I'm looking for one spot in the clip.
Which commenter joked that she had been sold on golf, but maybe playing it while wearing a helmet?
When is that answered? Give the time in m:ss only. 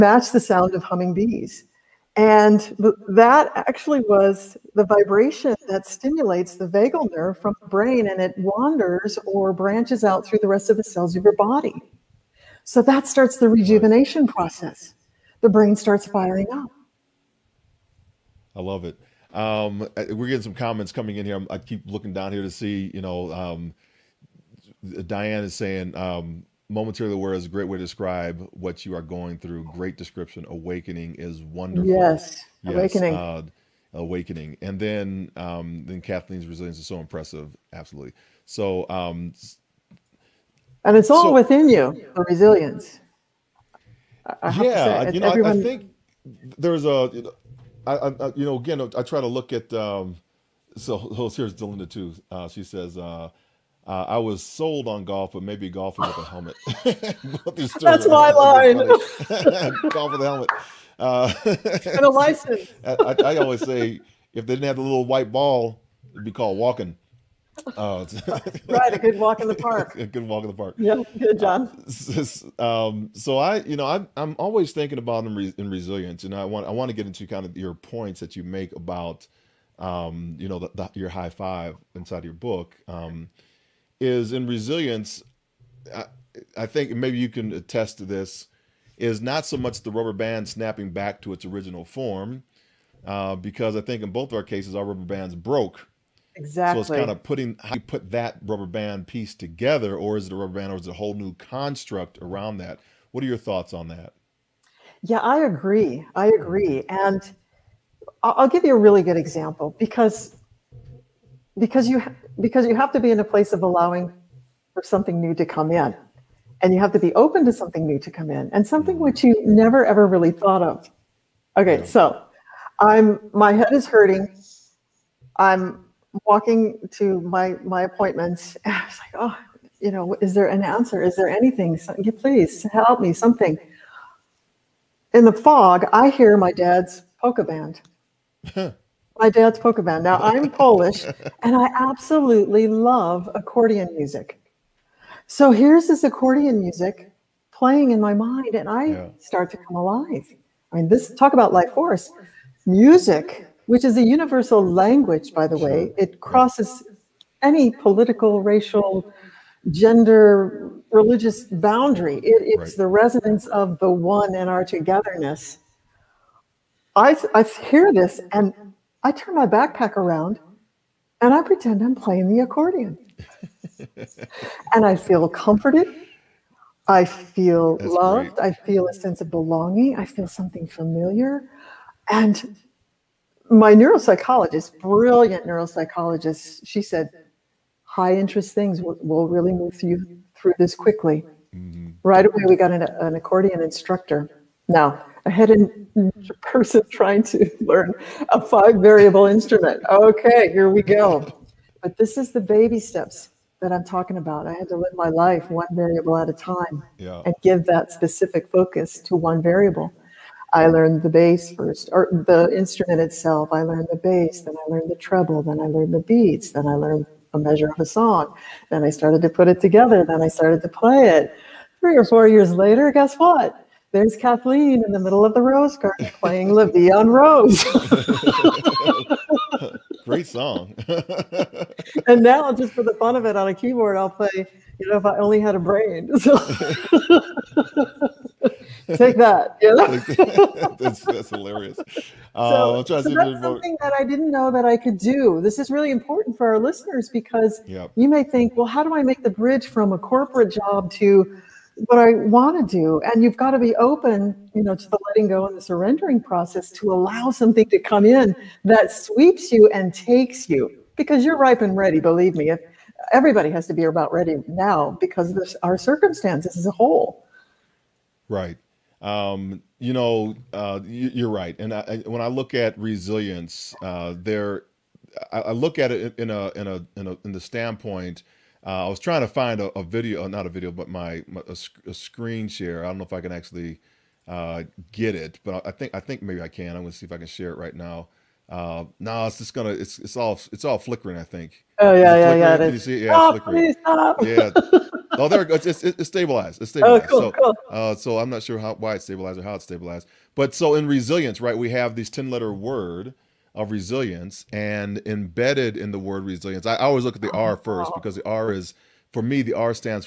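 0:51.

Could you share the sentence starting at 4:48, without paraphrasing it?
Uh, no, nah, it's just gonna it's it's all it's all flickering.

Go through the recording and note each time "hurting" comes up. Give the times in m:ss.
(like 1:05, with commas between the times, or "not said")
2:03.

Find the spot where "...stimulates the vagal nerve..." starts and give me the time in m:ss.
0:05.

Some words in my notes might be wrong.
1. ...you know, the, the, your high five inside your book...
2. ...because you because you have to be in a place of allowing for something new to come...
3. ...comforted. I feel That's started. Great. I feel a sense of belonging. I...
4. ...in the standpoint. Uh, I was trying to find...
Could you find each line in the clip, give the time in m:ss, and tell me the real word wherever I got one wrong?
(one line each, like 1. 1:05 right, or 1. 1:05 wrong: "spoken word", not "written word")
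1. 1:20 right
2. 1:51 right
3. 2:55 wrong: "loved", not "started"
4. 4:37 right.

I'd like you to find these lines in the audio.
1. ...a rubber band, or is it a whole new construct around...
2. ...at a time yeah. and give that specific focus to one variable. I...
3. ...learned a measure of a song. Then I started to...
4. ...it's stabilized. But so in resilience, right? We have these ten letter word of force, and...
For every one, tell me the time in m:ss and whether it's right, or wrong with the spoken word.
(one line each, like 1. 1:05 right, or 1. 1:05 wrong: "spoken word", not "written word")
1. 1:40 right
2. 3:26 right
3. 3:36 right
4. 4:59 wrong: "resilience", not "force".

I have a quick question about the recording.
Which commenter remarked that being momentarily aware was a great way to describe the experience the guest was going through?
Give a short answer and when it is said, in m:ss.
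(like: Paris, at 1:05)
Diane, at 0:25.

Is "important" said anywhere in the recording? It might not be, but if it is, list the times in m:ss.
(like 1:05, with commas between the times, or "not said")
4:05.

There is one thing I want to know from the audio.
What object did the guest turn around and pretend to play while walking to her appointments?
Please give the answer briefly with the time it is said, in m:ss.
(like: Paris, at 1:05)
backpack, at 2:49.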